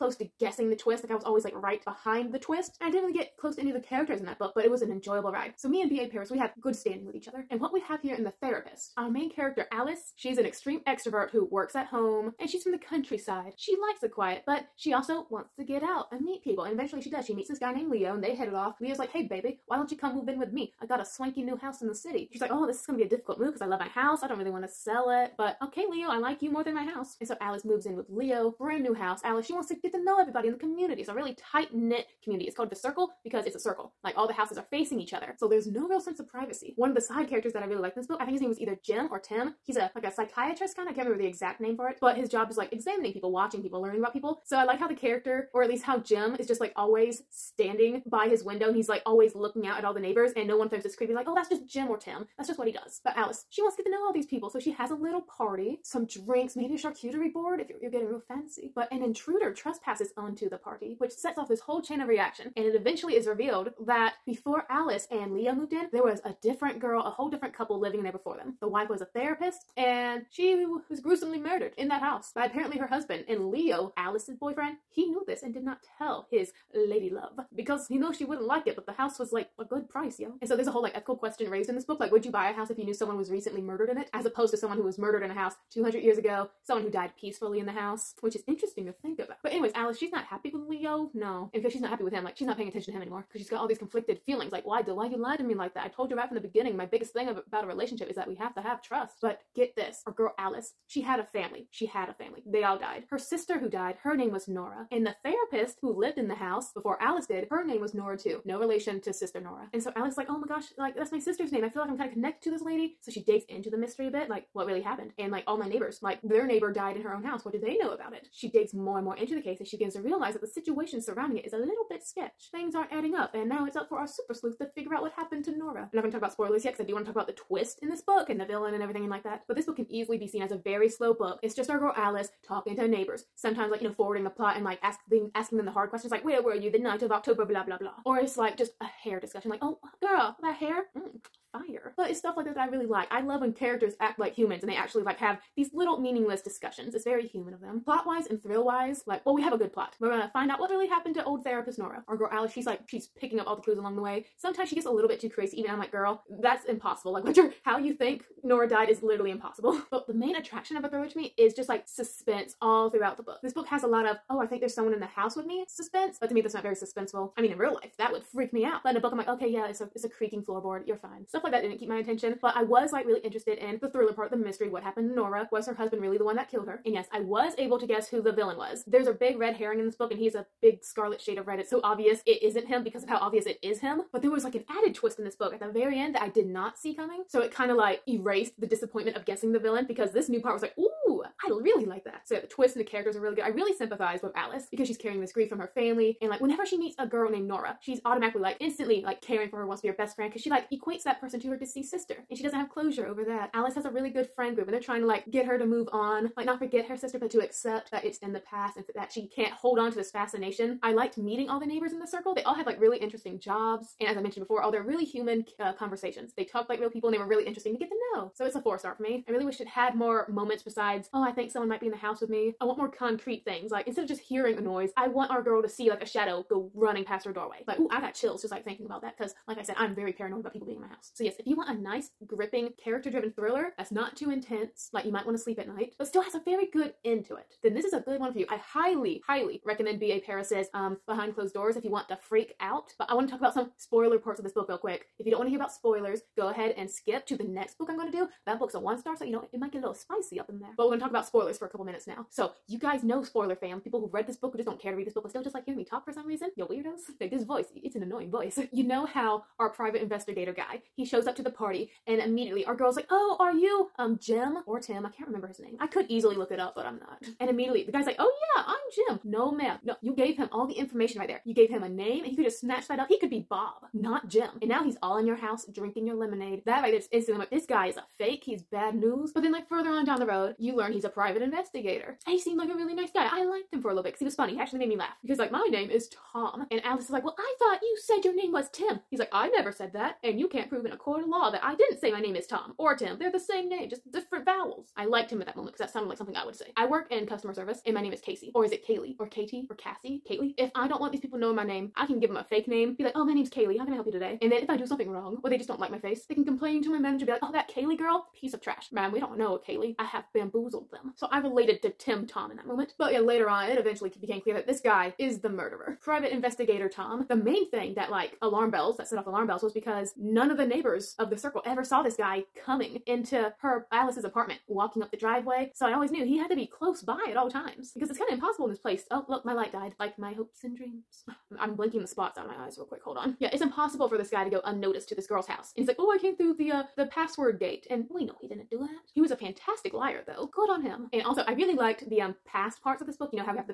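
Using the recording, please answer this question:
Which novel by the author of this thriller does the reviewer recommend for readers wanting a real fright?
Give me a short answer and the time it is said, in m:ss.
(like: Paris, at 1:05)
Behind Closed Doors, at 4:01.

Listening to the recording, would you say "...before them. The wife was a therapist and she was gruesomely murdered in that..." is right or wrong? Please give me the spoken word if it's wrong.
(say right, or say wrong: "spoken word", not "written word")
right.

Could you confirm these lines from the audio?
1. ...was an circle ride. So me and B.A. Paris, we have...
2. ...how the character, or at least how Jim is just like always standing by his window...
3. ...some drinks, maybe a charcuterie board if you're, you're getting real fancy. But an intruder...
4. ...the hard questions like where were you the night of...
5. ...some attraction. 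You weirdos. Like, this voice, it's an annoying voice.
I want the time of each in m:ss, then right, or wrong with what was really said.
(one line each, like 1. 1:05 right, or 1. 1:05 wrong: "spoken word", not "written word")
1. 0:04 wrong: "enjoyable", not "circle"
2. 0:44 right
3. 0:55 right
4. 2:15 right
5. 4:16 wrong: "reason", not "attraction".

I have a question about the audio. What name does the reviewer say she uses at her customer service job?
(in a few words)
Casey.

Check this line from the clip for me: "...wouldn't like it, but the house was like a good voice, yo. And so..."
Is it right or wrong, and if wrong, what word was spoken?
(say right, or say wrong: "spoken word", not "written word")
wrong: "price", not "voice".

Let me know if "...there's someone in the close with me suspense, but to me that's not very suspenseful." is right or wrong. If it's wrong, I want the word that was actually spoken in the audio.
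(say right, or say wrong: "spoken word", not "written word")
wrong: "house", not "close".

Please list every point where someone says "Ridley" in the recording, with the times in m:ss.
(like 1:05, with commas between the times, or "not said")
not said.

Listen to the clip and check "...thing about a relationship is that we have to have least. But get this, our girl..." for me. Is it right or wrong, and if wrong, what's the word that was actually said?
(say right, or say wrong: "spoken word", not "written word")
wrong: "trust", not "least".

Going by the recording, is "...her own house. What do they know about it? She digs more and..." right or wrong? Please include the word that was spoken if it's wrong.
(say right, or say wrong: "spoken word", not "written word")
right.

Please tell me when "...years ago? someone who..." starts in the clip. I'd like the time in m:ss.
1:25.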